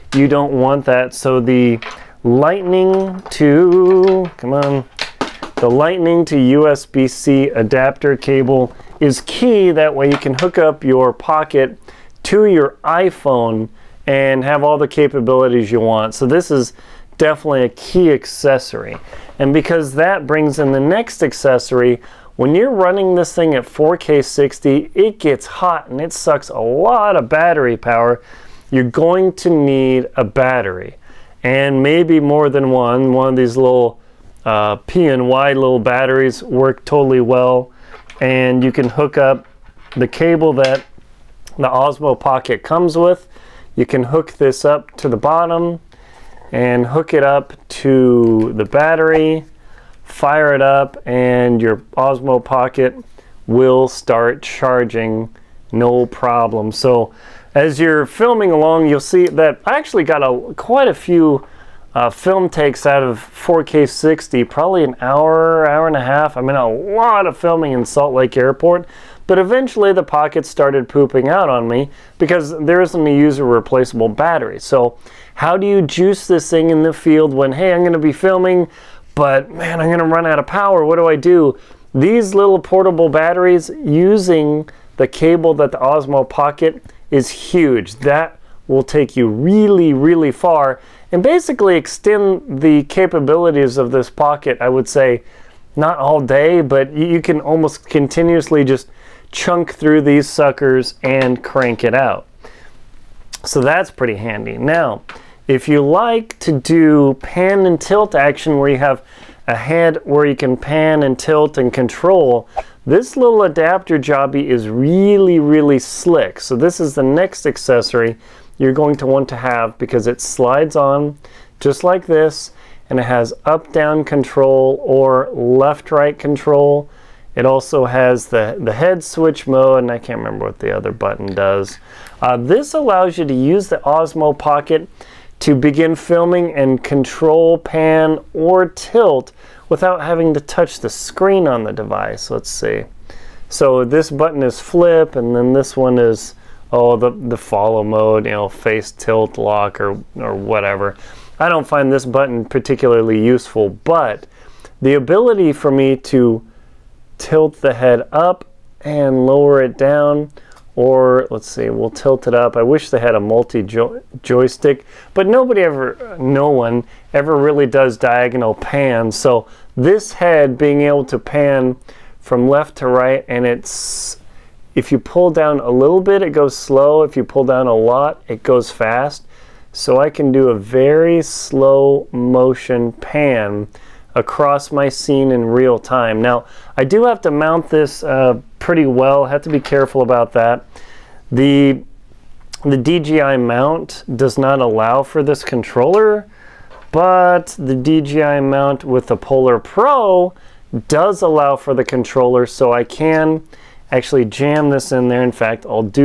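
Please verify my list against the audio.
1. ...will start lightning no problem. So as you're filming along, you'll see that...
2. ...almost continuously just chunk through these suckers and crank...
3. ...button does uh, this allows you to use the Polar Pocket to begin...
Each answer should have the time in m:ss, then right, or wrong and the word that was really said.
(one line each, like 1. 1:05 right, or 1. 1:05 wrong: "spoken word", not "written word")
1. 0:53 wrong: "charging", not "lightning"
2. 1:37 right
3. 2:10 wrong: "Osmo", not "Polar".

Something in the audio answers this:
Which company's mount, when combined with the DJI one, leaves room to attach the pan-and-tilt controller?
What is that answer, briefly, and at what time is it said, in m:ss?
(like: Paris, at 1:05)
Polar Pro, at 3:19.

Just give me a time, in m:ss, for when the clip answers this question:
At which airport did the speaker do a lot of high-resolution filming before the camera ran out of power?
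1:07.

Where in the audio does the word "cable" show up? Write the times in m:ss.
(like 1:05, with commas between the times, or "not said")
0:08, 0:40, 1:25.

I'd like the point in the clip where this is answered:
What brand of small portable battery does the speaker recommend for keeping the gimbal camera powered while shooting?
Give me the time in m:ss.
0:34.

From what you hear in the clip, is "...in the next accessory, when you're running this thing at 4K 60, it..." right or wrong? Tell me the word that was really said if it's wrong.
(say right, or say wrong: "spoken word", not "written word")
right.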